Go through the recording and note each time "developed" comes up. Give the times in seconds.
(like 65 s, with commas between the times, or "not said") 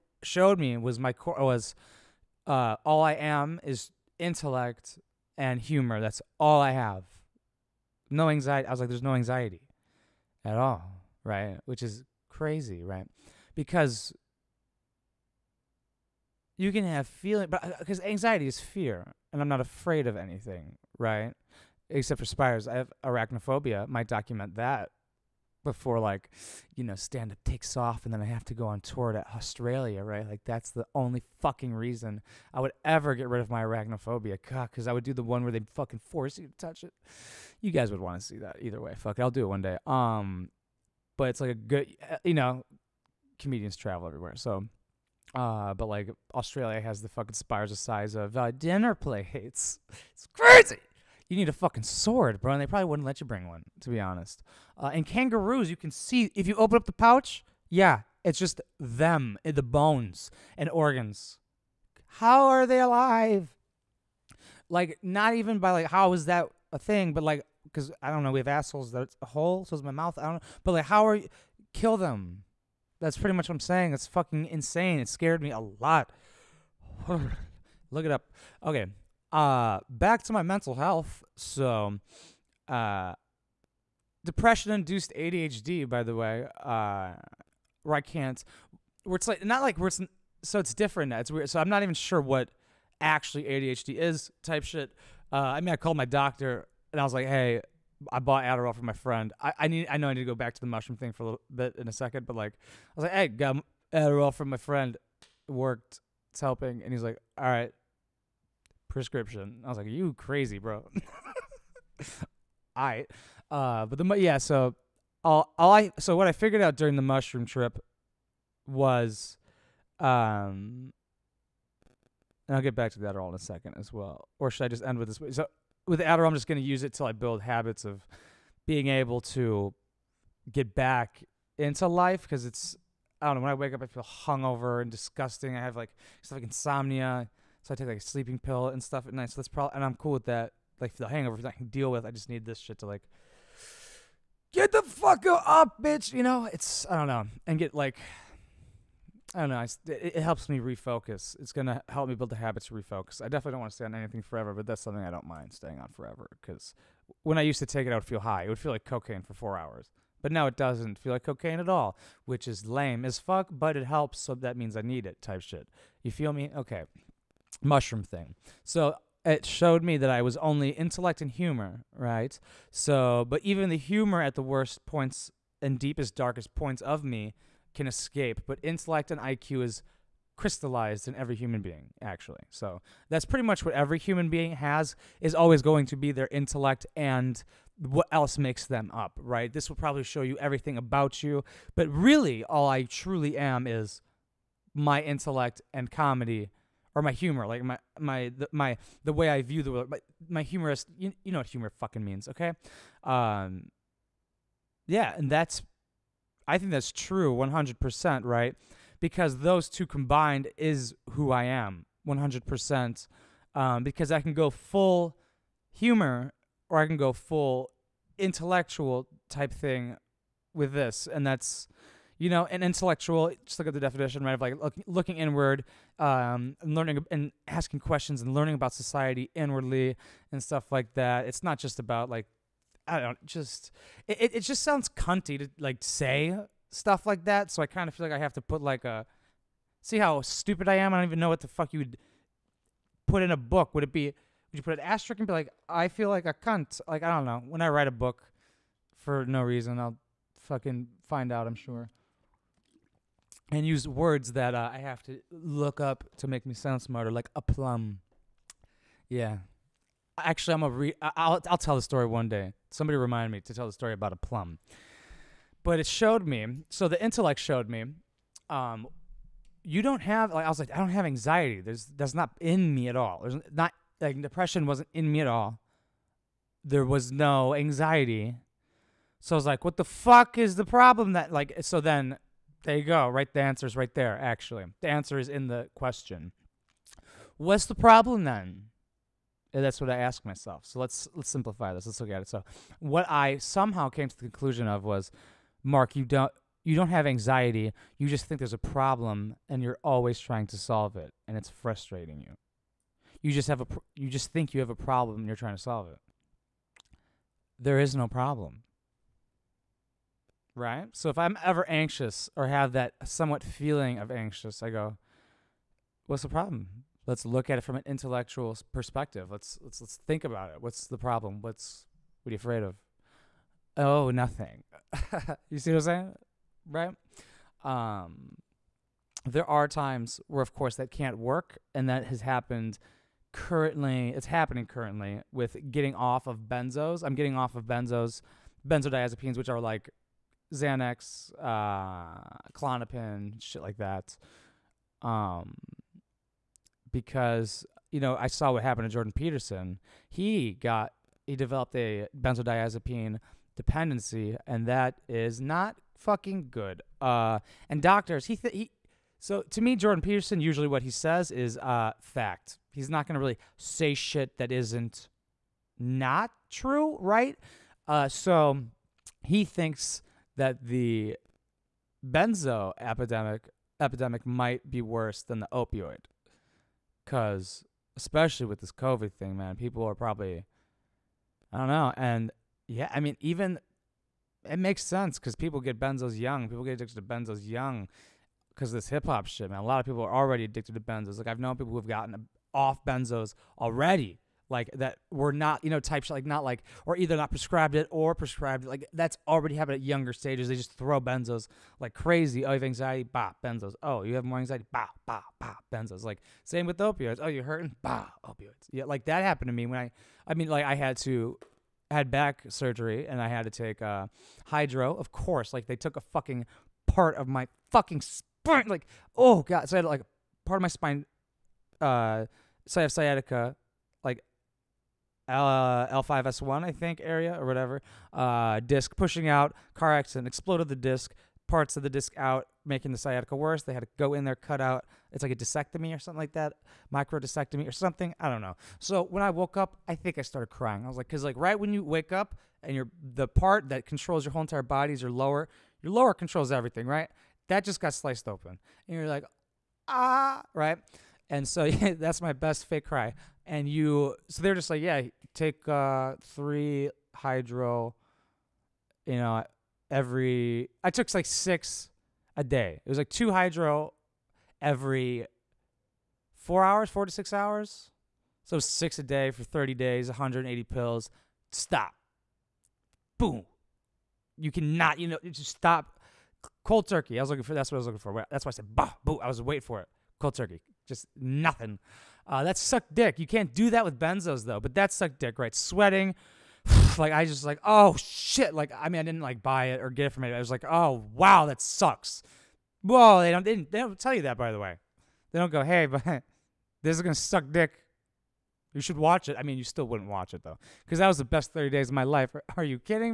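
351 s.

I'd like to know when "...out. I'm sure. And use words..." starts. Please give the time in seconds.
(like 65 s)
251 s.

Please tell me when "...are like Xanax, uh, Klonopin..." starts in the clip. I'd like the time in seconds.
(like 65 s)
339 s.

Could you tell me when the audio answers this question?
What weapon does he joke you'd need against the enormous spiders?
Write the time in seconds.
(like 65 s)
51 s.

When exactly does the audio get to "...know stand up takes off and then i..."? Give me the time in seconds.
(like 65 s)
26 s.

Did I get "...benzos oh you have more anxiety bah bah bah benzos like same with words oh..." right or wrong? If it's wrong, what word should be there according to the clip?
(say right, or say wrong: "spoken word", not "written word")
wrong: "opioids", not "words".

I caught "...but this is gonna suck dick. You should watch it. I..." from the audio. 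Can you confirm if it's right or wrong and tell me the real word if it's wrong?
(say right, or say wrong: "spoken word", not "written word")
right.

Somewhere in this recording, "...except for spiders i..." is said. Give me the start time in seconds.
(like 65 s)
21 s.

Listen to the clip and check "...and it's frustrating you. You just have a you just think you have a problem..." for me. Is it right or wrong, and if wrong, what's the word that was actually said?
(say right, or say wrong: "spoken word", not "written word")
right.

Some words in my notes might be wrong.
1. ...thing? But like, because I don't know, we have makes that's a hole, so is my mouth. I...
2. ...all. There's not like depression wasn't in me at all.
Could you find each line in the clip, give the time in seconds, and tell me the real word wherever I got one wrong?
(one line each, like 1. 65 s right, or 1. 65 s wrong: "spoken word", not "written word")
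1. 66 s wrong: "assholes", not "makes"
2. 272 s right.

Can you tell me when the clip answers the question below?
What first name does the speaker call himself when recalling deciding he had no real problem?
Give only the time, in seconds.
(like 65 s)
295 s.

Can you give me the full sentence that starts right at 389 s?
A lot of people are already addicted to benzos.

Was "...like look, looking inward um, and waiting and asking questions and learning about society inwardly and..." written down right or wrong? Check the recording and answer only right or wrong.
wrong.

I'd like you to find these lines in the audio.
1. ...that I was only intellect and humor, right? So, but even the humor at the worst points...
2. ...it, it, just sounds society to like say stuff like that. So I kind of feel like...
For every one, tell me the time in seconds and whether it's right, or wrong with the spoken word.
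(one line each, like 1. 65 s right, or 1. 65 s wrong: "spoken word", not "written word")
1. 169 s right
2. 234 s wrong: "cunty", not "society".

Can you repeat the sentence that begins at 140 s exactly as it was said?
Like the hangover I can deal with.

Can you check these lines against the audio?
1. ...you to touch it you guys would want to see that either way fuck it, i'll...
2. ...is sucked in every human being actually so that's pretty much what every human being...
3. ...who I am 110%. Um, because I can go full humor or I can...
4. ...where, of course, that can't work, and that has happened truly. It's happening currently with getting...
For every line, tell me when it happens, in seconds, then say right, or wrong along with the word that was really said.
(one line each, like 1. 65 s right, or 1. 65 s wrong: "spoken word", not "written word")
1. 36 s right
2. 179 s wrong: "crystallized", not "sucked"
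3. 211 s wrong: "100", not "110"
4. 330 s wrong: "currently", not "truly".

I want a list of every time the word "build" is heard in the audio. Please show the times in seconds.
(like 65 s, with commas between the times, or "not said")
127 s, 152 s.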